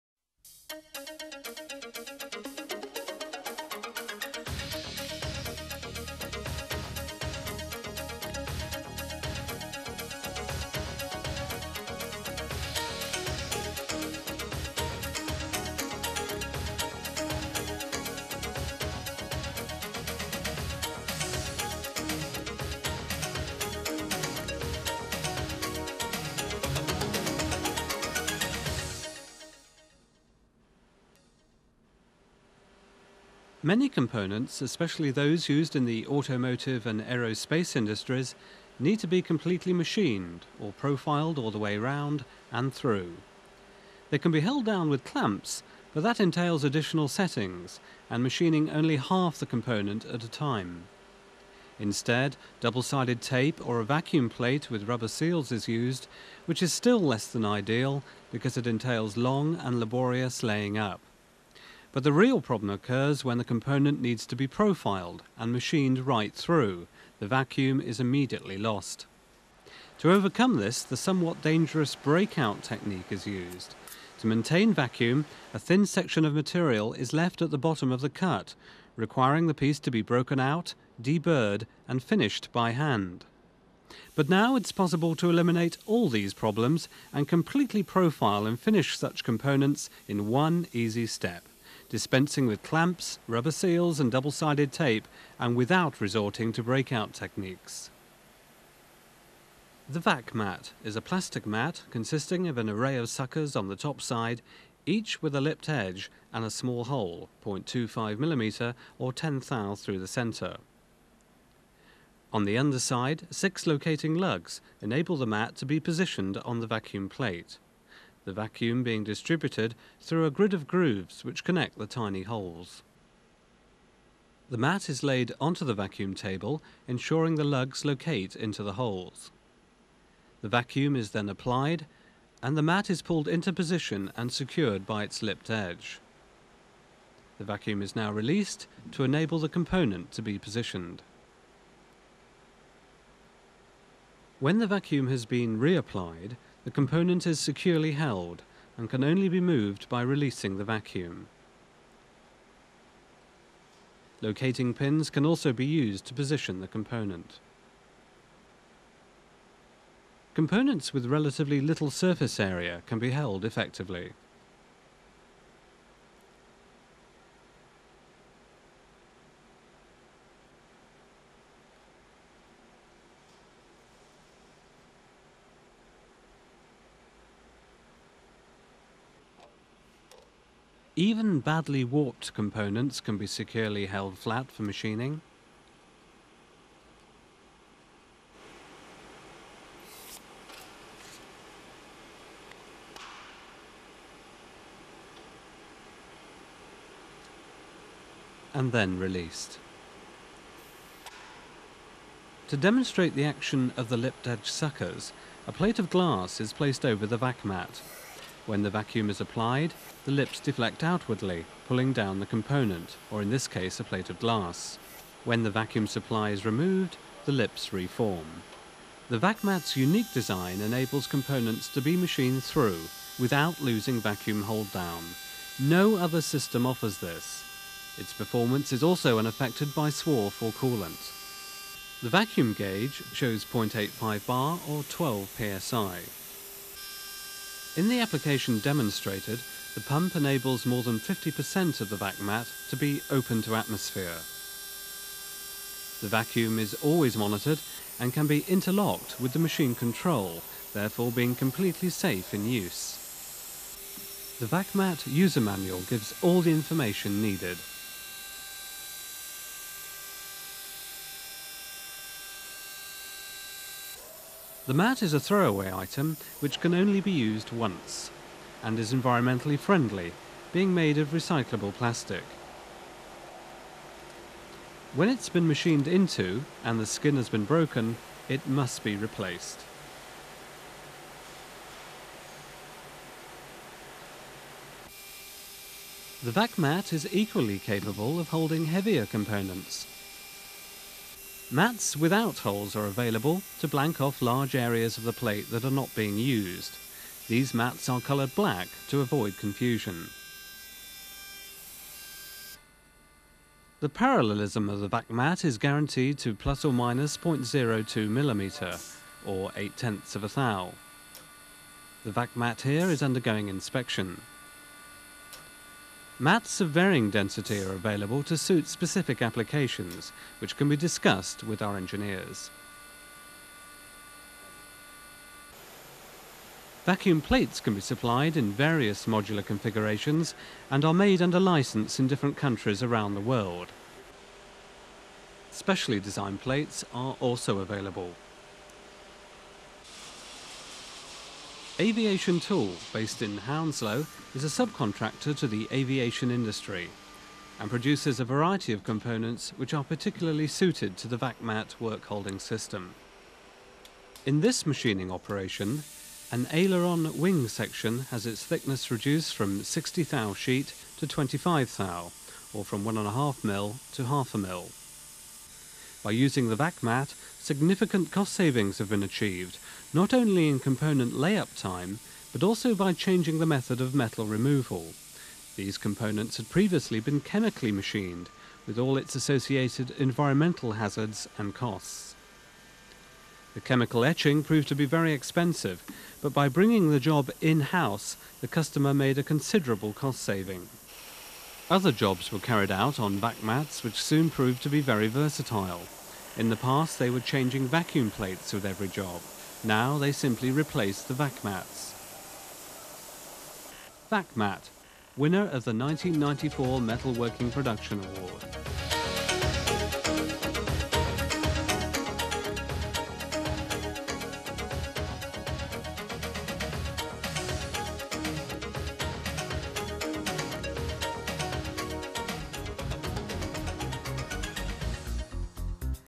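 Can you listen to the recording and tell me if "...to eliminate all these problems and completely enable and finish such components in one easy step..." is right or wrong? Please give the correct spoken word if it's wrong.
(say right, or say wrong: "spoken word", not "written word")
wrong: "profile", not "enable".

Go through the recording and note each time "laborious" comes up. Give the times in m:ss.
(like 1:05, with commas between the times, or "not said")
0:59.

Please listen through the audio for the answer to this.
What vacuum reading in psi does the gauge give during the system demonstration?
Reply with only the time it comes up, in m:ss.
3:54.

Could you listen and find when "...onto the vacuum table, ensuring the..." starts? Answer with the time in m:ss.
2:05.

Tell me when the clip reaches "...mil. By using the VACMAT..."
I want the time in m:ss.
6:04.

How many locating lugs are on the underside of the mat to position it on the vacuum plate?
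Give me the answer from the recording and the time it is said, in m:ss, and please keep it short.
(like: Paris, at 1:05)
6, at 1:53.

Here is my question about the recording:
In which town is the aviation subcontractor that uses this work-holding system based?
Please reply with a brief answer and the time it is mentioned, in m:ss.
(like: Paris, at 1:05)
Hounslow, at 5:43.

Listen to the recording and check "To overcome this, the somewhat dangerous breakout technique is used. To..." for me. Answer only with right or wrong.
right.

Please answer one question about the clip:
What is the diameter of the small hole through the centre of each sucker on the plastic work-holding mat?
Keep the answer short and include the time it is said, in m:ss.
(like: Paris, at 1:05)
0.25mm, at 1:47.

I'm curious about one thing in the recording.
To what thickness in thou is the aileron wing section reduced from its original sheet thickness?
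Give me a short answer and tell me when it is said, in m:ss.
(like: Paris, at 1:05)
25 thou, at 6:01.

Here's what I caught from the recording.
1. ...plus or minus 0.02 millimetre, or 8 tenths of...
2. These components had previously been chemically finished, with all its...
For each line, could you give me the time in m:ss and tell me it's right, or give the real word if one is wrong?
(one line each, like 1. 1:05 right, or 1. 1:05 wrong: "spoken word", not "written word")
1. 5:06 right
2. 6:15 wrong: "machined", not "finished".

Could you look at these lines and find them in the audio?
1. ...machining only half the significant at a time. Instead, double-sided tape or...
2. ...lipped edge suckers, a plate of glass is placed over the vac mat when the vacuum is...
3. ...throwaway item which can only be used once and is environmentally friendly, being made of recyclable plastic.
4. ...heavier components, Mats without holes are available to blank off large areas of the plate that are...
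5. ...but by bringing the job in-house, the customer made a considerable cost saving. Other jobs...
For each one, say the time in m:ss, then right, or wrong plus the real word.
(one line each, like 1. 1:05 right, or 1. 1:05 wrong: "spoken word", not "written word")
1. 0:48 wrong: "component", not "significant"
2. 3:23 right
3. 4:25 right
4. 4:48 right
5. 6:26 right.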